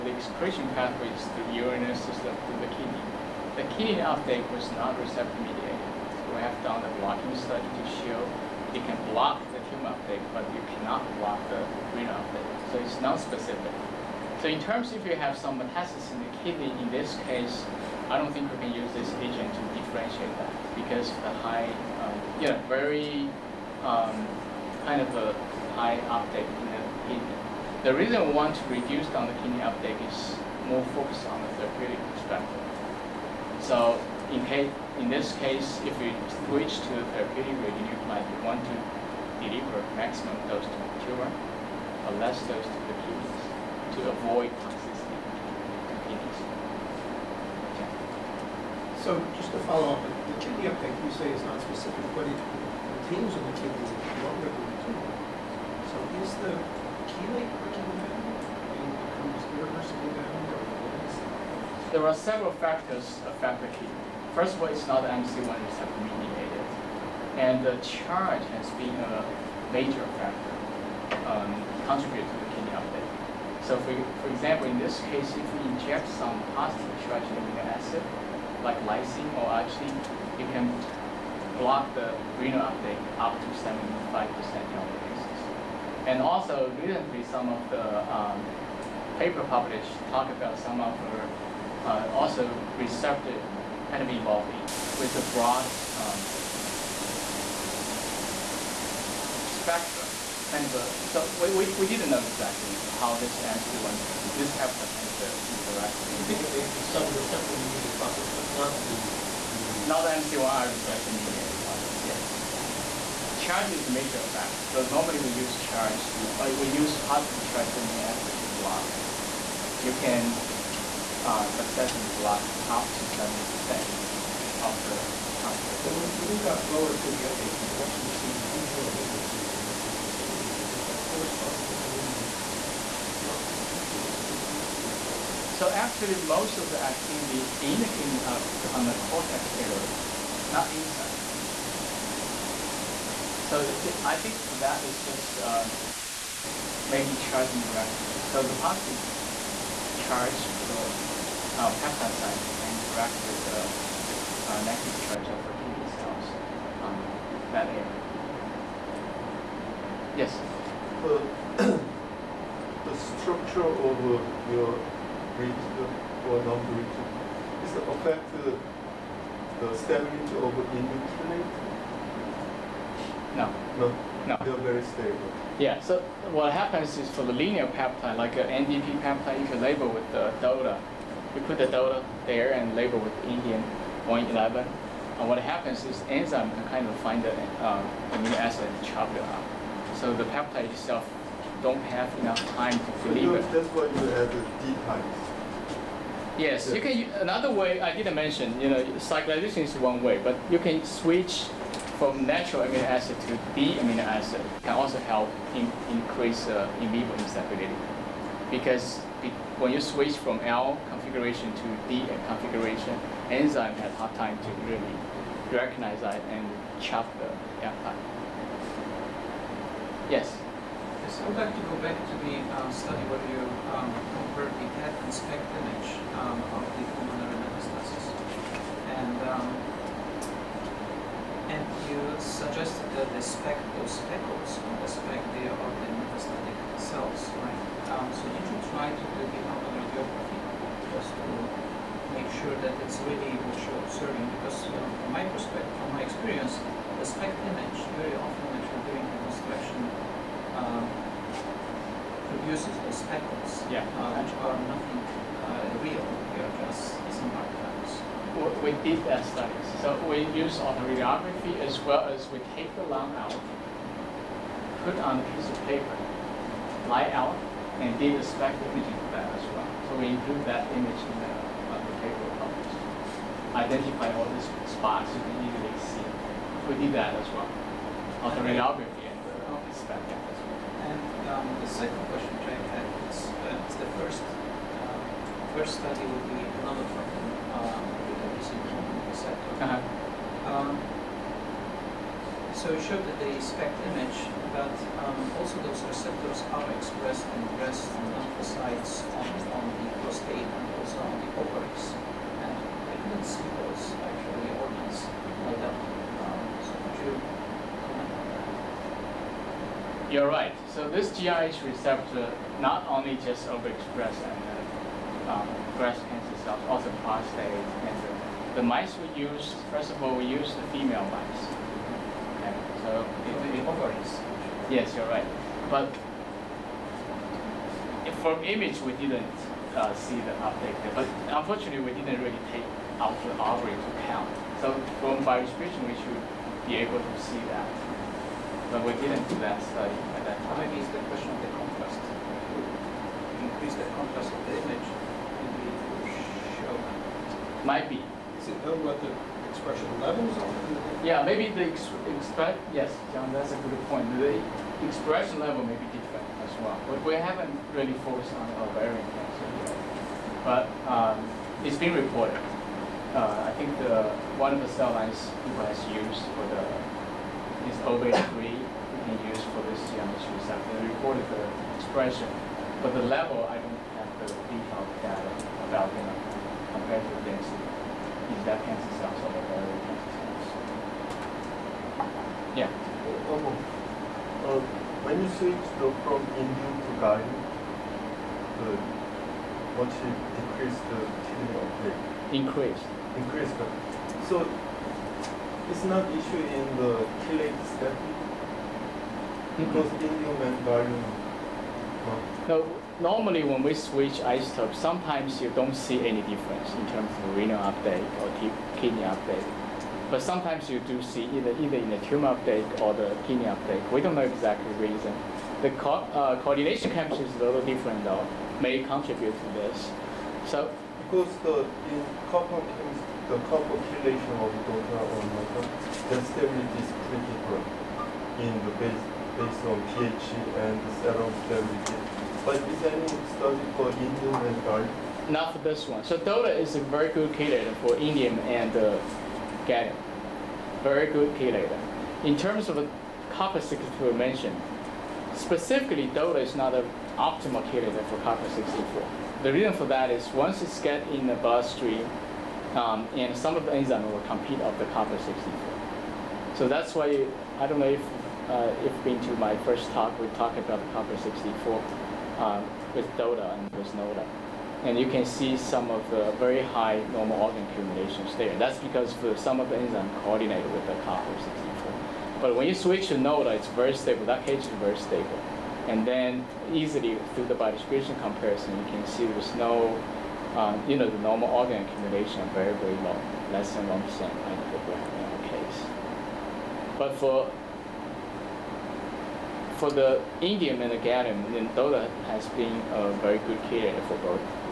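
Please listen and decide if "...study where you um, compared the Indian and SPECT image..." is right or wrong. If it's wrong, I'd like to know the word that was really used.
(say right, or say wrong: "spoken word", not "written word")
wrong: "PET", not "Indian".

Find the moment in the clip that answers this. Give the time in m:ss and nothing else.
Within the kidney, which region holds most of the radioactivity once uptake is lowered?
2:19.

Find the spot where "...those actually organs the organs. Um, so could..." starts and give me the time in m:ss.
5:03.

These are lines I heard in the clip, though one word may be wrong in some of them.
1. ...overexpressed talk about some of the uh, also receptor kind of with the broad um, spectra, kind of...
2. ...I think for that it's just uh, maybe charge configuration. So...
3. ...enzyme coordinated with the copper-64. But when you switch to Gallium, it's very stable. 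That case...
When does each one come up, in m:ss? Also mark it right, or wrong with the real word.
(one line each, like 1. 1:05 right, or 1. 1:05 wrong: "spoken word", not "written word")
1. 1:29 wrong: "published", not "overexpressed"
2. 2:24 wrong: "interaction", not "configuration"
3. 7:49 wrong: "Nota", not "Gallium".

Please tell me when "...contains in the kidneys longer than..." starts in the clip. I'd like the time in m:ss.
0:53.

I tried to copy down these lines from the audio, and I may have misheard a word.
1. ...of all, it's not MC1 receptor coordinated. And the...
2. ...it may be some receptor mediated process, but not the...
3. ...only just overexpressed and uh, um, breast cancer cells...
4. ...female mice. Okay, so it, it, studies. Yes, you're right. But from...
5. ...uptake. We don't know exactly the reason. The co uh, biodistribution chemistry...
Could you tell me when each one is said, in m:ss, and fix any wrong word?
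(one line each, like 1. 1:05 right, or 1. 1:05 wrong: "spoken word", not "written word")
1. 1:04 wrong: "mediated", not "coordinated"
2. 1:46 right
3. 5:12 right
4. 5:20 wrong: "ovaries", not "studies"
5. 6:53 wrong: "coordination", not "biodistribution".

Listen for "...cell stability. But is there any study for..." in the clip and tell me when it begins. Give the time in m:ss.
7:11.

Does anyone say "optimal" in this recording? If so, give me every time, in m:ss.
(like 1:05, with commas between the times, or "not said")
7:27.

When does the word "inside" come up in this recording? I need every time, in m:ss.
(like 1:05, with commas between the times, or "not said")
2:20.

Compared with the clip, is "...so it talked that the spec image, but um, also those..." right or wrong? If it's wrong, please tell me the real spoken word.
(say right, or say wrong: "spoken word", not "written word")
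wrong: "showed", not "talked".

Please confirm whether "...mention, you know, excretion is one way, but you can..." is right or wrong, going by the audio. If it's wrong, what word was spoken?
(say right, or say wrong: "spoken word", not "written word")
wrong: "cyclization", not "excretion".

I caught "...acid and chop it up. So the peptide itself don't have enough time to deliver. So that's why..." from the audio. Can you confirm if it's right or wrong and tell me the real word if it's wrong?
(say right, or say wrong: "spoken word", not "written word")
right.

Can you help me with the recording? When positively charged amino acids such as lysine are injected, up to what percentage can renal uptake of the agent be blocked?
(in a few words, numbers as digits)
75%.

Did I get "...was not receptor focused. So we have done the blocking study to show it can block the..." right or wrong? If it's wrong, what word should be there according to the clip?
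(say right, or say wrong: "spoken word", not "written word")
wrong: "mediated", not "focused".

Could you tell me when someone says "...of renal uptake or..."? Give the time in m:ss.
6:47.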